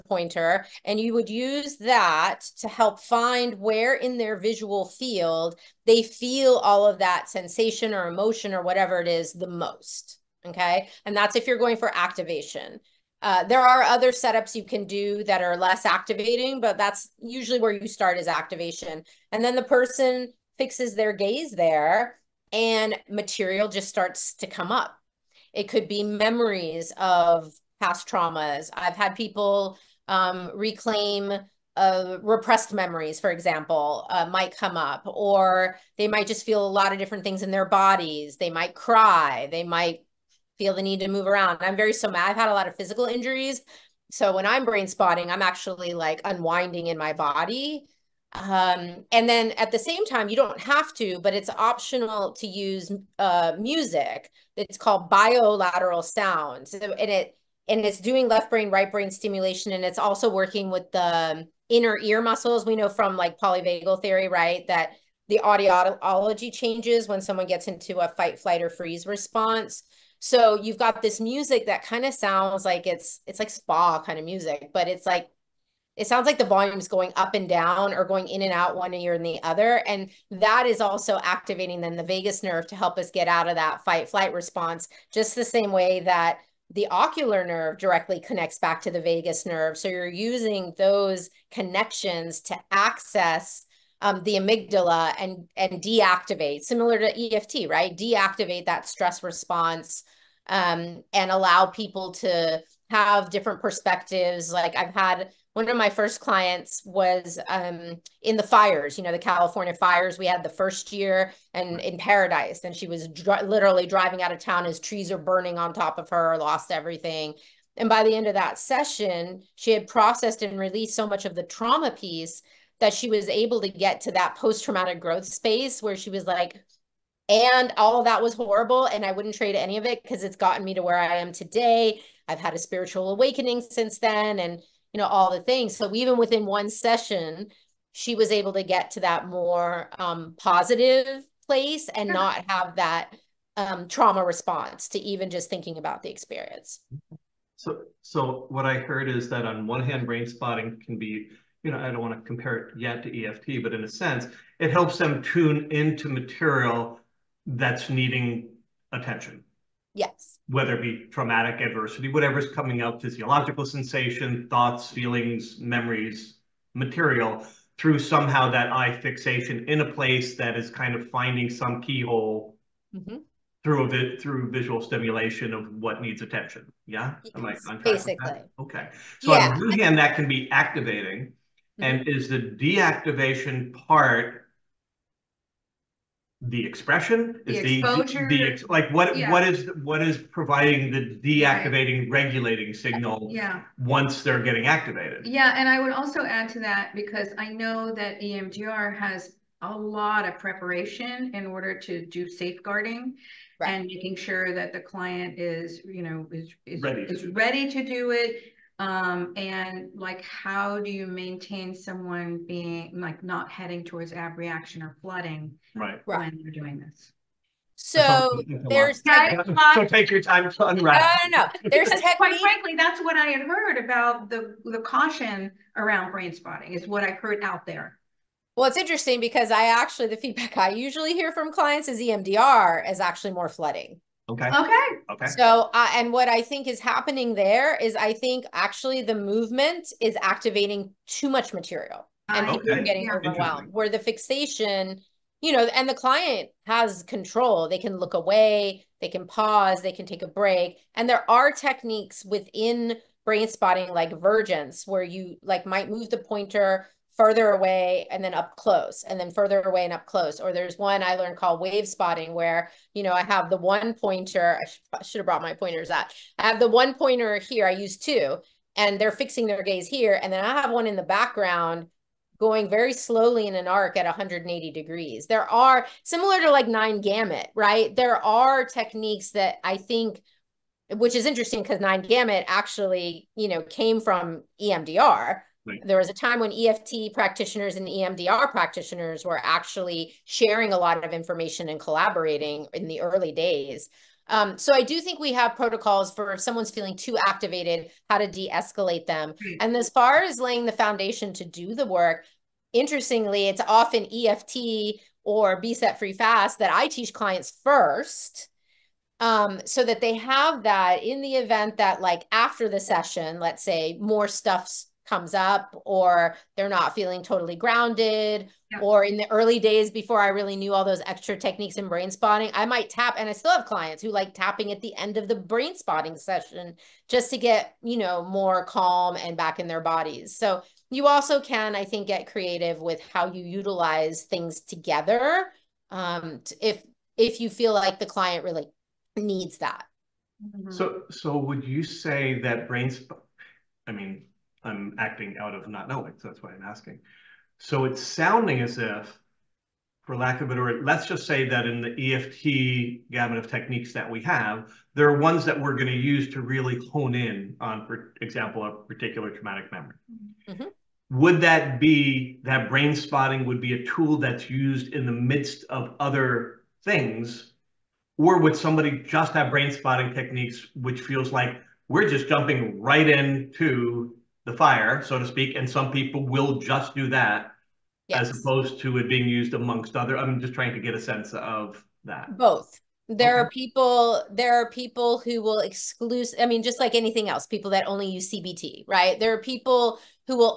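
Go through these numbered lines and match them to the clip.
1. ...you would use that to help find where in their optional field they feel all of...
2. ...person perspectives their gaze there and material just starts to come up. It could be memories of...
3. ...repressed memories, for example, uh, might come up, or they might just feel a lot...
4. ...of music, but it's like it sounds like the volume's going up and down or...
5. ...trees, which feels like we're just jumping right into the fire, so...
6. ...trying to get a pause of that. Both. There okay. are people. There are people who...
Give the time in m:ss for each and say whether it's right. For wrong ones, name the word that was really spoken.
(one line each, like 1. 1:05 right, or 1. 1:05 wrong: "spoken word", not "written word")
1. 0:00 wrong: "visual", not "optional"
2. 0:19 wrong: "fixes", not "perspectives"
3. 0:32 right
4. 1:14 right
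5. 6:10 wrong: "techniques", not "trees"
6. 6:20 wrong: "sense", not "pause".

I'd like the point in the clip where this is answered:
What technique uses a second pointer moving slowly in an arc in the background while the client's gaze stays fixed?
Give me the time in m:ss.
4:21.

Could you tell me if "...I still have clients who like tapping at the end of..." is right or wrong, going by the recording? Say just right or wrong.
right.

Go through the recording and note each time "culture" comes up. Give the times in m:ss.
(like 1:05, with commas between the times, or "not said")
not said.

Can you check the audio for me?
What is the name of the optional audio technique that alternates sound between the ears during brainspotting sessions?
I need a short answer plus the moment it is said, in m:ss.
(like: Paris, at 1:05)
bilateral sounds, at 0:55.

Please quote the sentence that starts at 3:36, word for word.
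you're doing this so there's so take your time to unwrap.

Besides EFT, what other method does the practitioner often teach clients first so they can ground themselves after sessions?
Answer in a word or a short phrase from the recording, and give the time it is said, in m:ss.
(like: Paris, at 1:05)
Be Set Free Fast, at 5:05.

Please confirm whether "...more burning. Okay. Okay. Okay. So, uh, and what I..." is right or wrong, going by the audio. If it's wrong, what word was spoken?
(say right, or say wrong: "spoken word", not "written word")
wrong: "flooding", not "burning".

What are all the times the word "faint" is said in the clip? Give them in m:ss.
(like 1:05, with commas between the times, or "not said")
not said.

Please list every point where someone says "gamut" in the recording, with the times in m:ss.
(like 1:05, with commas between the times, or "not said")
4:37, 4:42, 5:53.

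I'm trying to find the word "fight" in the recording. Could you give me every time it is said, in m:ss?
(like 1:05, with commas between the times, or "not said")
1:08, 1:23.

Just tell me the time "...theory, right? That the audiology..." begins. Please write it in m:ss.
1:04.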